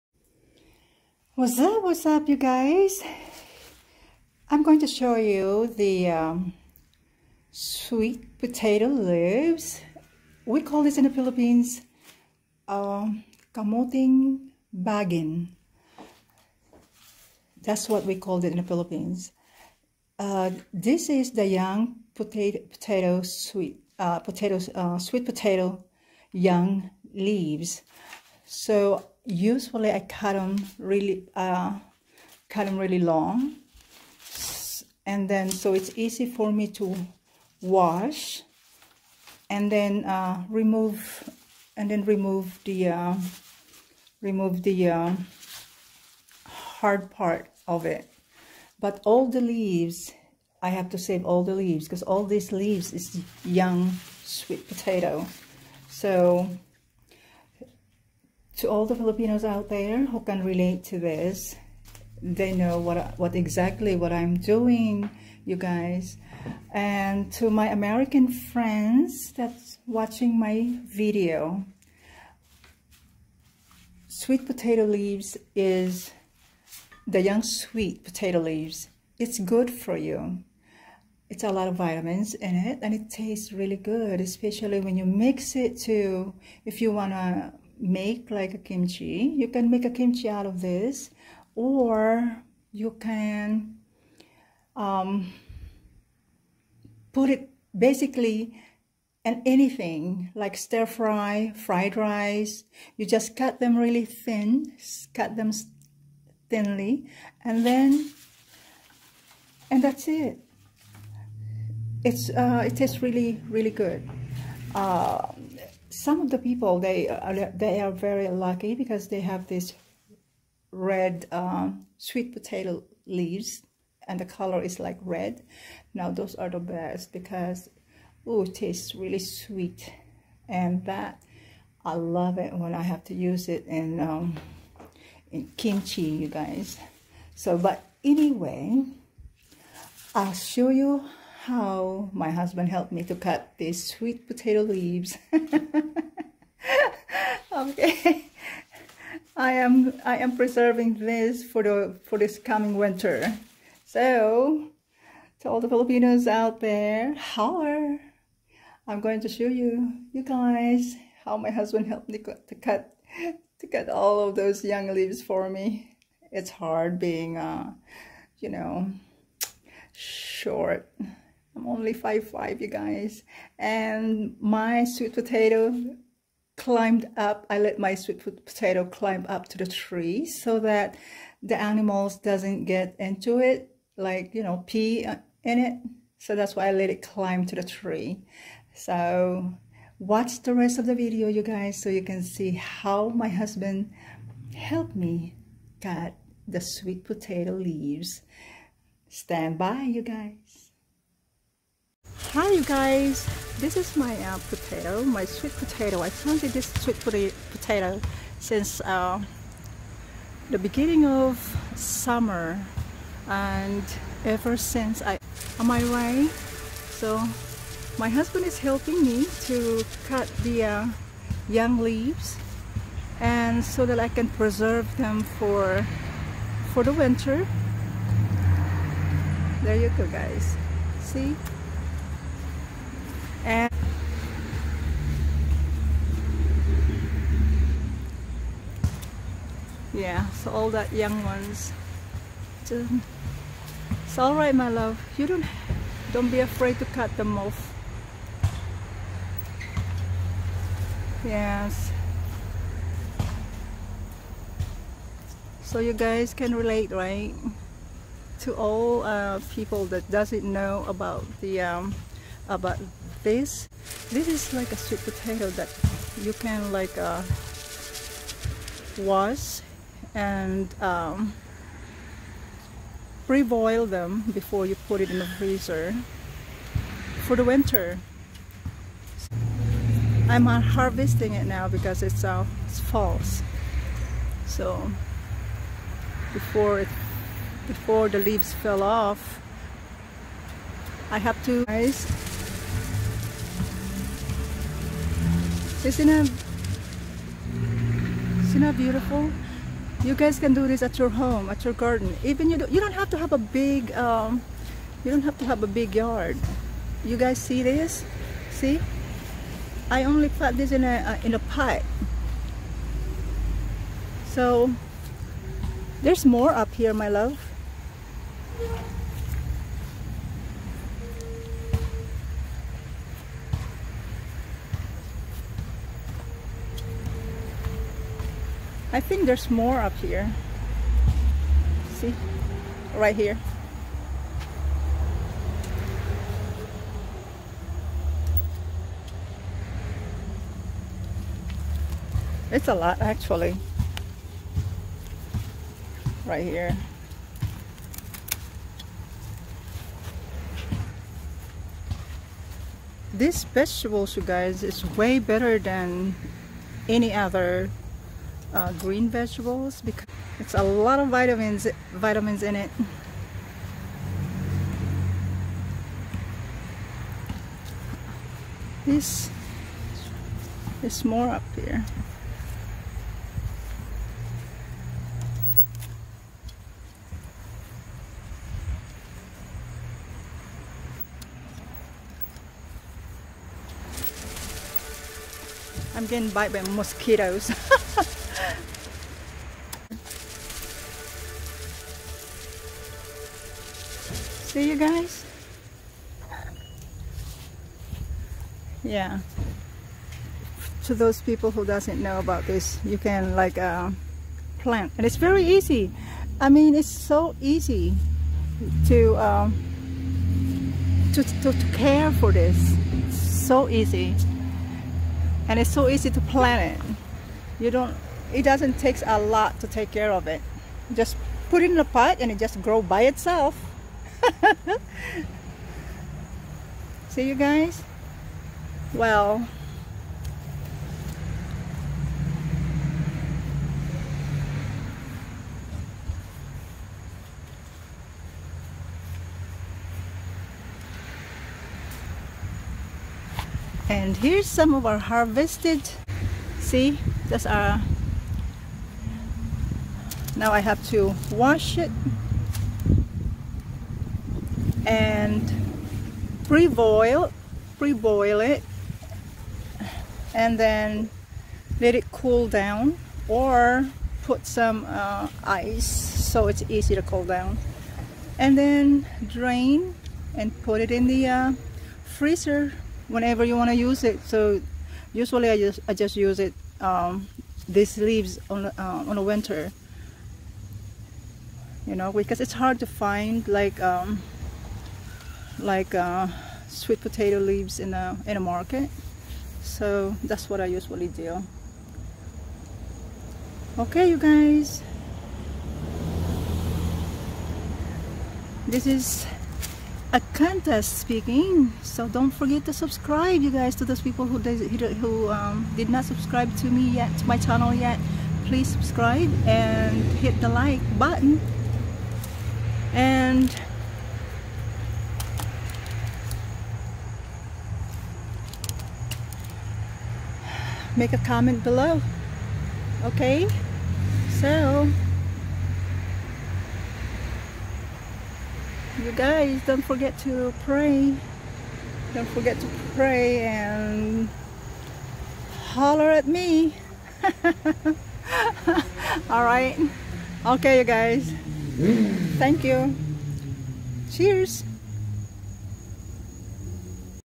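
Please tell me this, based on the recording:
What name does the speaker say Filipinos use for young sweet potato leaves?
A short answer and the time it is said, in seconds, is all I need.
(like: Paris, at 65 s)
kamoting bagin, at 13 s.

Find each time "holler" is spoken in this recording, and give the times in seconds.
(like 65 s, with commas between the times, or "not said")
157 s, 535 s.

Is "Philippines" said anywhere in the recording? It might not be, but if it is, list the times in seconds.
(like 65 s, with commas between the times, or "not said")
11 s, 18 s.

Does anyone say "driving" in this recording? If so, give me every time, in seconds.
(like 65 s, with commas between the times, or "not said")
not said.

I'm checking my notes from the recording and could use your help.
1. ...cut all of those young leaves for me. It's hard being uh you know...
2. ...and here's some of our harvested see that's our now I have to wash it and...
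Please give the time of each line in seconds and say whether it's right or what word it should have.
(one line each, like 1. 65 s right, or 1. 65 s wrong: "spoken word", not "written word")
1. 163 s right
2. 443 s right.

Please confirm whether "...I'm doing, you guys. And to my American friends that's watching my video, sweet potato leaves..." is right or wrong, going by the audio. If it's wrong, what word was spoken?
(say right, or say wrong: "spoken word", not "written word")
right.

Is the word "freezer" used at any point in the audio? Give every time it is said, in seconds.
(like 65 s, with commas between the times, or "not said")
275 s, 472 s.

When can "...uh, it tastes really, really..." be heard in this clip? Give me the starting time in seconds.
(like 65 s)
112 s.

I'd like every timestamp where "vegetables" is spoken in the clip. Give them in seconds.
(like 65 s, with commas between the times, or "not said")
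353 s, 359 s.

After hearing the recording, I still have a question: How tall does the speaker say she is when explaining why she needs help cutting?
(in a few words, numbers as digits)
5'5".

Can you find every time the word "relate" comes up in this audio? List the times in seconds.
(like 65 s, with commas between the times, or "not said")
60 s, 256 s.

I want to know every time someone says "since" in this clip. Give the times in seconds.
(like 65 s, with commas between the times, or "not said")
208 s, 214 s.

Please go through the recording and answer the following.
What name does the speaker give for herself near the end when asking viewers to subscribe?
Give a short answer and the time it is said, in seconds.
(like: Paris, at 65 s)
Acantha, at 500 s.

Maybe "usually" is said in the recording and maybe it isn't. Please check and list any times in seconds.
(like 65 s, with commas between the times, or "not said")
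29 s, 475 s, 490 s.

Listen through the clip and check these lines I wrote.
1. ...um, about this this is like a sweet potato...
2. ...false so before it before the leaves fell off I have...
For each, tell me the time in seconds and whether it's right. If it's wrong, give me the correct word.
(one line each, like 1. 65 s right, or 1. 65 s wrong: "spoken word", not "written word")
1. 261 s right
2. 282 s right.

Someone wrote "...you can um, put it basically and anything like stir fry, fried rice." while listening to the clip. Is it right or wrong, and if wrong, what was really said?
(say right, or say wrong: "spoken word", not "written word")
right.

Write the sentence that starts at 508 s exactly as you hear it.
Please subscribe and hit the like button.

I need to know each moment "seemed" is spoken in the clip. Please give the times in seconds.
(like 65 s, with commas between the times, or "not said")
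not said.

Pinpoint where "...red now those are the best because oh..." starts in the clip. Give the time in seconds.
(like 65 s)
125 s.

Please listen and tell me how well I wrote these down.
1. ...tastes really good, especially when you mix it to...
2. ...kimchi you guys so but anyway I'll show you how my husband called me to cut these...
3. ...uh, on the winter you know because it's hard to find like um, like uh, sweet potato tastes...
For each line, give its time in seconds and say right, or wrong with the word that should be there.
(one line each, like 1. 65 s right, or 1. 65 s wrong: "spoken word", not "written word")
1. 83 s right
2. 135 s wrong: "helped", not "called"
3. 478 s wrong: "leaves", not "tastes".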